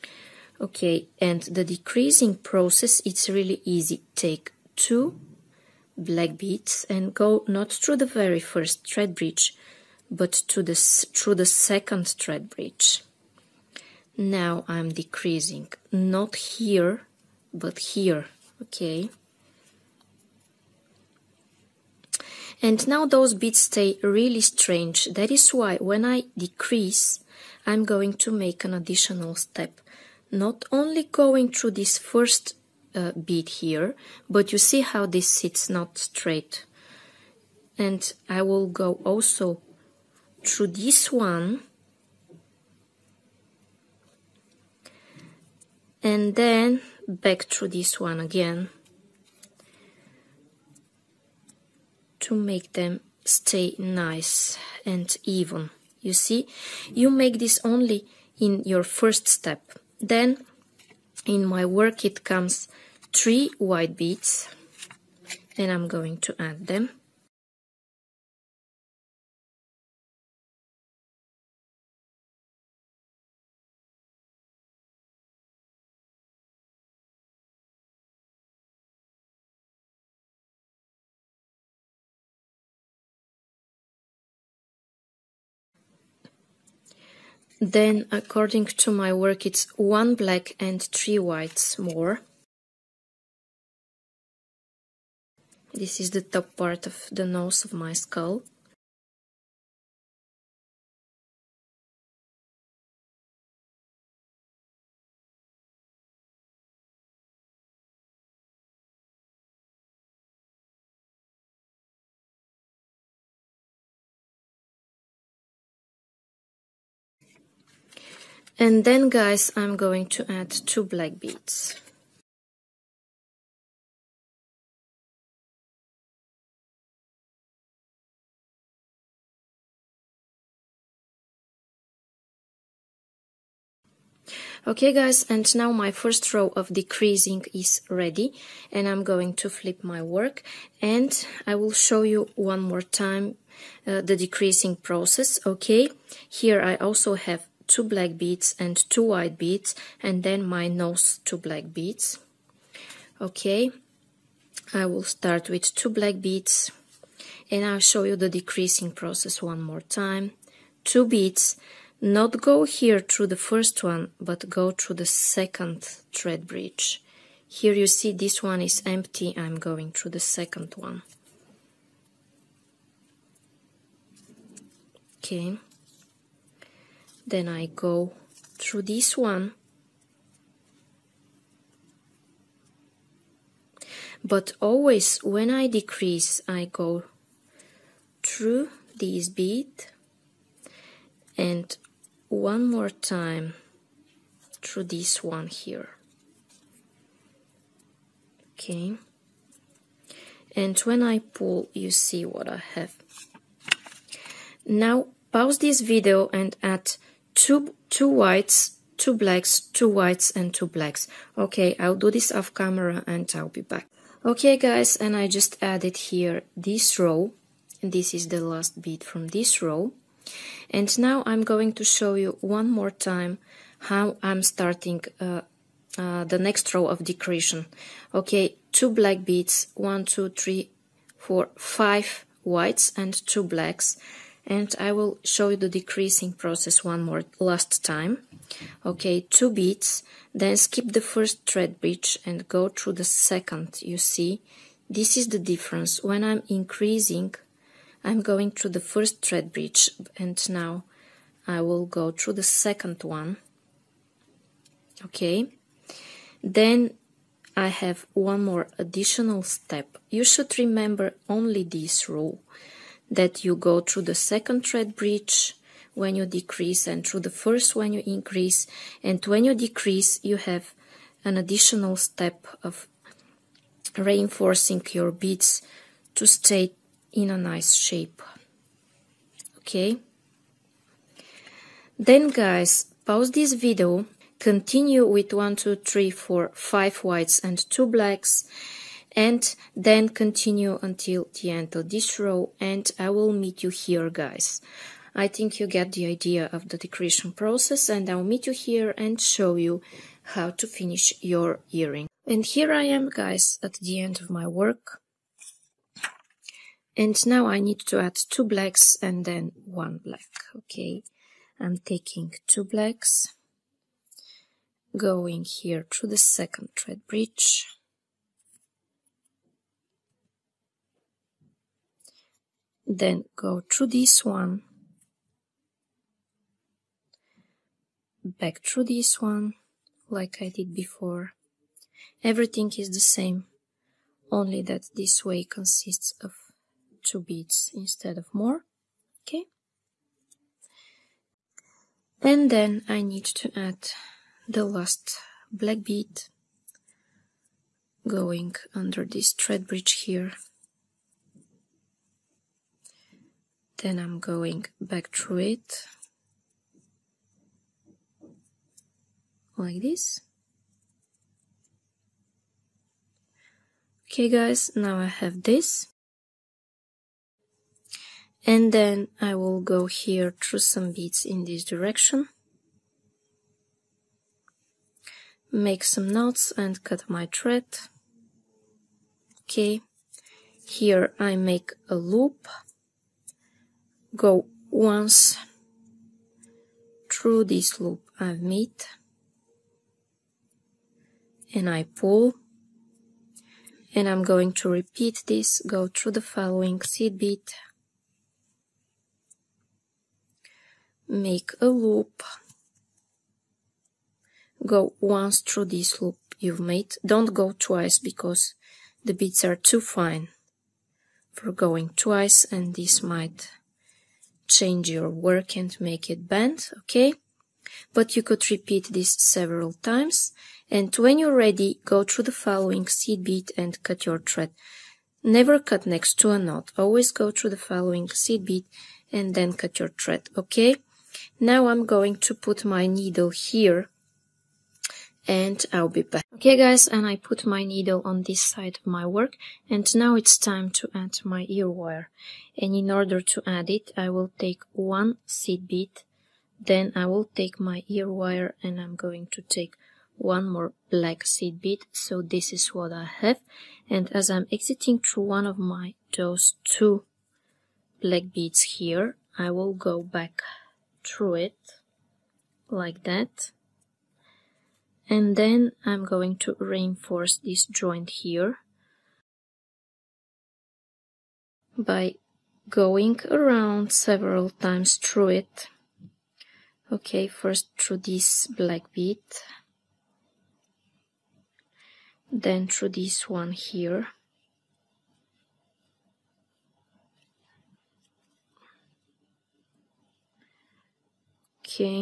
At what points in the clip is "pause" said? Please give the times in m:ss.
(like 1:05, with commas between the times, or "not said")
3:25, 4:43.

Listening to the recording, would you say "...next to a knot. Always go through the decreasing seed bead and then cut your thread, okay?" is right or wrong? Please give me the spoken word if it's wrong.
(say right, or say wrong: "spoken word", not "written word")
wrong: "following", not "decreasing".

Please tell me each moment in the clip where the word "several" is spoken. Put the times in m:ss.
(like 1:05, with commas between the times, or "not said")
6:59, 7:53.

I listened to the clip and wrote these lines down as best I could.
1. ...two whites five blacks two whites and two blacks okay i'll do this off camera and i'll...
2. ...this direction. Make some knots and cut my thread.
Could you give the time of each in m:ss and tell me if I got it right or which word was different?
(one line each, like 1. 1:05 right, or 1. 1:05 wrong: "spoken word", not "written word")
1. 3:27 wrong: "two", not "five"
2. 6:11 right.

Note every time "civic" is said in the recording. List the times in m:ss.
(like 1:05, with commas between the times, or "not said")
not said.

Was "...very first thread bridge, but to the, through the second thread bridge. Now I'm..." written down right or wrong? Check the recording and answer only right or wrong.
right.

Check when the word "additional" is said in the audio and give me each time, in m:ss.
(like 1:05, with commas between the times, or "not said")
0:28, 4:18, 4:31.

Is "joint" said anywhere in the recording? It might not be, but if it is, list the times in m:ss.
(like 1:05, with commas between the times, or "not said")
7:47.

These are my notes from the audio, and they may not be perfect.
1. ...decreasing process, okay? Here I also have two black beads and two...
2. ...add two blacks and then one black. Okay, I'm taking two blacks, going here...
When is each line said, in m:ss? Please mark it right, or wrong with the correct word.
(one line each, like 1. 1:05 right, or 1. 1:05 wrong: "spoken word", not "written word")
1. 2:24 right
2. 5:07 right.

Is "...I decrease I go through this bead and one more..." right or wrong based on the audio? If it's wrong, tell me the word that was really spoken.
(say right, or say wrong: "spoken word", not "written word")
right.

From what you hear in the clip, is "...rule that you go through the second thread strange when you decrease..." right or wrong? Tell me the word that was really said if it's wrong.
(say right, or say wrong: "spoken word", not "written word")
wrong: "bridge", not "strange".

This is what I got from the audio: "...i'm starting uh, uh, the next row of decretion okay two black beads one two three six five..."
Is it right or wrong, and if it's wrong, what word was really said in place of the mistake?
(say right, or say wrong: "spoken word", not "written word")
wrong: "four", not "six".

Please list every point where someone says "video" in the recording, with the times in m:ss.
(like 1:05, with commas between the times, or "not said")
3:25, 4:43.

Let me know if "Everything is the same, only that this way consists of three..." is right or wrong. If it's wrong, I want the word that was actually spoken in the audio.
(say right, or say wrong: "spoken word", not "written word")
wrong: "two", not "three".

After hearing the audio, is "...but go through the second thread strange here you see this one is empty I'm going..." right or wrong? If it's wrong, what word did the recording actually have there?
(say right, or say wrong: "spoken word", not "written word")
wrong: "bridge", not "strange".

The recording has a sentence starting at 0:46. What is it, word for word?
And then back through this one again to make them stay nice and even.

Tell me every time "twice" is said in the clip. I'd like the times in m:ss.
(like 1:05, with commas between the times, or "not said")
6:47, 6:51.